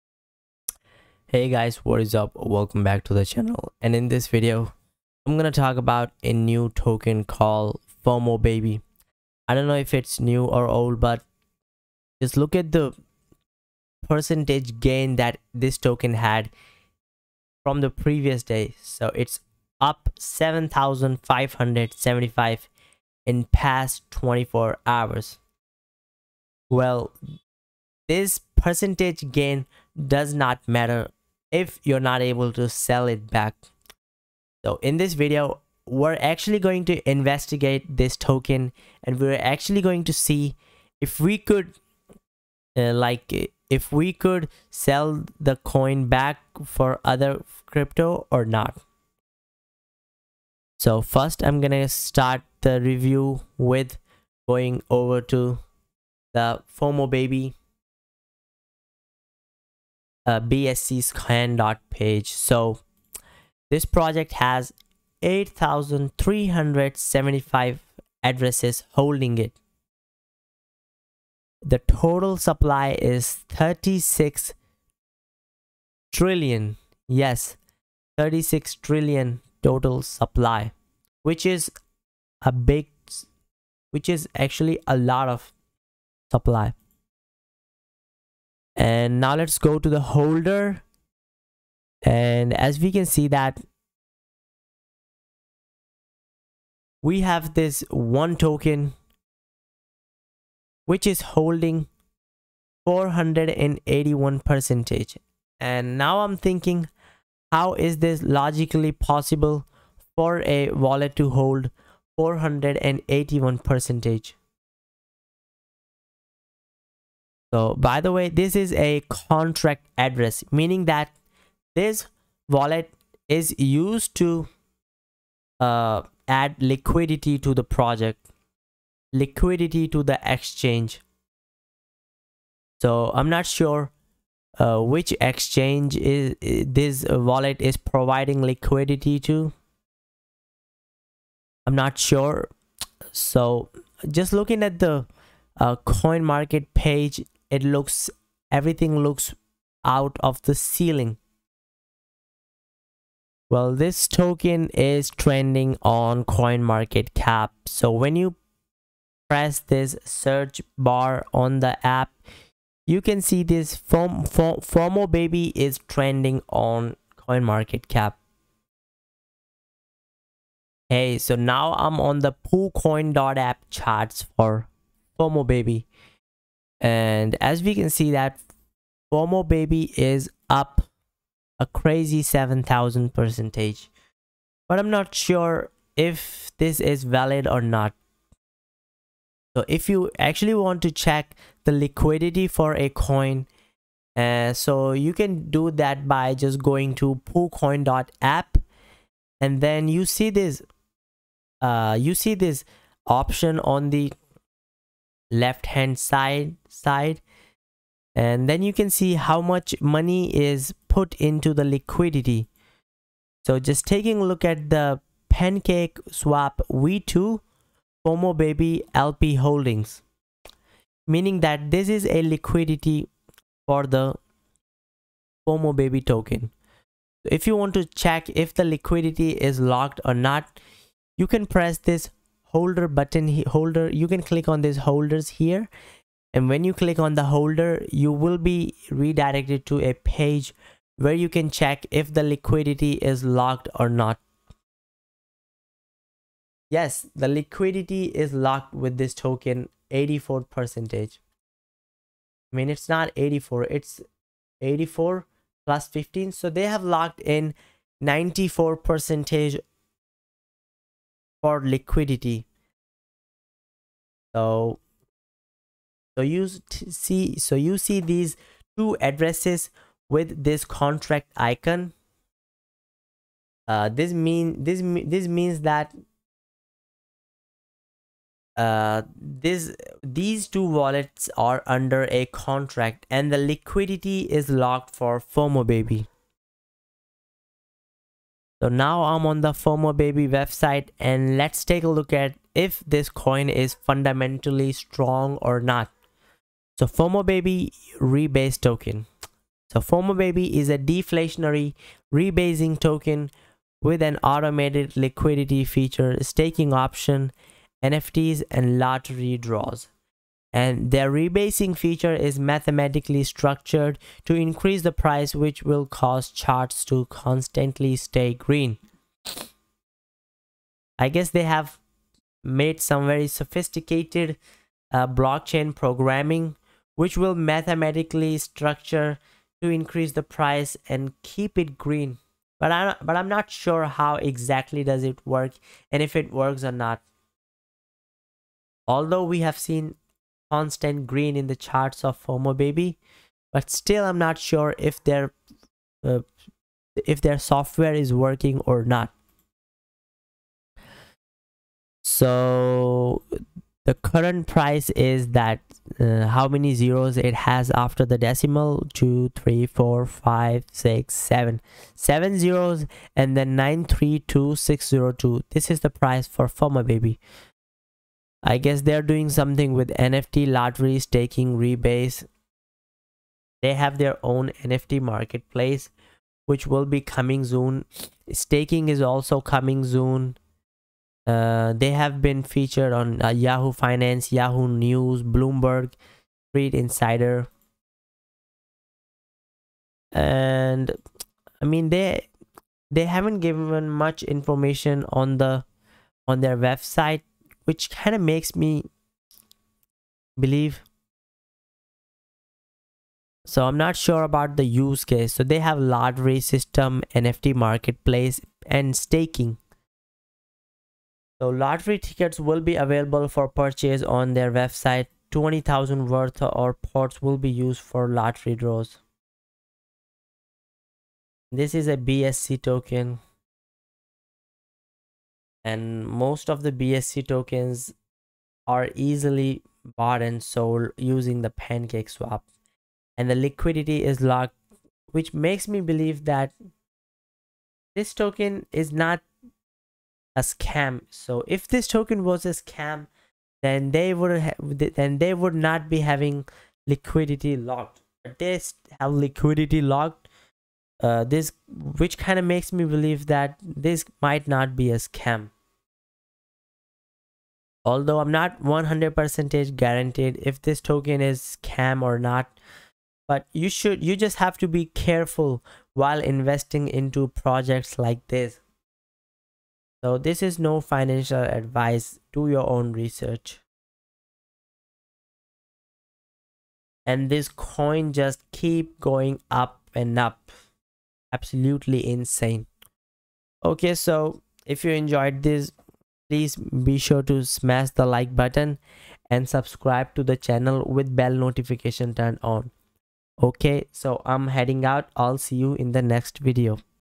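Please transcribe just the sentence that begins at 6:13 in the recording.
They have their own NFT marketplace, which will be coming soon.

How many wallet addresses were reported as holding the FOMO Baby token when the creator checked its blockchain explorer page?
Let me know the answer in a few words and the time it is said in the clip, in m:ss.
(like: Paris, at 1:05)
8,375, at 1:05.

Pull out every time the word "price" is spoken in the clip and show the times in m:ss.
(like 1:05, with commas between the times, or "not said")
5:14, 5:30, 5:54, 6:05.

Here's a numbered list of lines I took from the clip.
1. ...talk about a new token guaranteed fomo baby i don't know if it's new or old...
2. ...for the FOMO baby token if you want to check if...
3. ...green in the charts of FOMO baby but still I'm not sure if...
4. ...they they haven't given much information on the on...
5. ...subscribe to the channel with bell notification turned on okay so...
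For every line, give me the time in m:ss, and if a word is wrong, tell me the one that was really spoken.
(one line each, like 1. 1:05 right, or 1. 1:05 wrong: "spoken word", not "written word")
1. 0:05 wrong: "called", not "guaranteed"
2. 3:43 right
3. 5:41 right
4. 6:31 right
5. 8:09 right.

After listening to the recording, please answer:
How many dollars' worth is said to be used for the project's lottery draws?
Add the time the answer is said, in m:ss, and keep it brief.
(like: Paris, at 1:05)
20,000, at 6:55.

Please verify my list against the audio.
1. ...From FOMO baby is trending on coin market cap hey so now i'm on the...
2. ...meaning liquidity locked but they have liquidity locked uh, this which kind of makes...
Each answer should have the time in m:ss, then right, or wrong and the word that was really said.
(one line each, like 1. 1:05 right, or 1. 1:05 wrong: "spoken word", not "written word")
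1. 2:43 right
2. 7:26 wrong: "having", not "meaning".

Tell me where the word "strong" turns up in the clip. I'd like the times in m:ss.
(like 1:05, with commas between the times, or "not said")
4:54.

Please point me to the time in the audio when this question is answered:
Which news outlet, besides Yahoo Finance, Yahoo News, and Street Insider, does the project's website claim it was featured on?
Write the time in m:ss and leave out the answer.
6:25.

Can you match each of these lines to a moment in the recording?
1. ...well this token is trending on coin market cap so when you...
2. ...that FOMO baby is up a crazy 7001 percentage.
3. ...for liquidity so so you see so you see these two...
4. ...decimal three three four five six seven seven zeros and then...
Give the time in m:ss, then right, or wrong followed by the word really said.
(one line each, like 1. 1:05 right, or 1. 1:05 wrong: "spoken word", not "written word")
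1. 2:33 right
2. 2:58 wrong: "7000", not "7001"
3. 4:21 right
4. 5:58 wrong: "two", not "three".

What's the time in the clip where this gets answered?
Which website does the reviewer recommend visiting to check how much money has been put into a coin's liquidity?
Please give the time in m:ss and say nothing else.
3:17.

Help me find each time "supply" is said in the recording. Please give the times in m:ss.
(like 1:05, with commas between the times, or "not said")
1:12, 1:20, 1:26.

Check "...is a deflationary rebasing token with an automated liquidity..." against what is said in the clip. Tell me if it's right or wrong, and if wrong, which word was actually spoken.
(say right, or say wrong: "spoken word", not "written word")
right.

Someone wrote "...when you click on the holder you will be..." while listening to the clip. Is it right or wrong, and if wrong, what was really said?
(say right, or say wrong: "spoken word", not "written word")
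right.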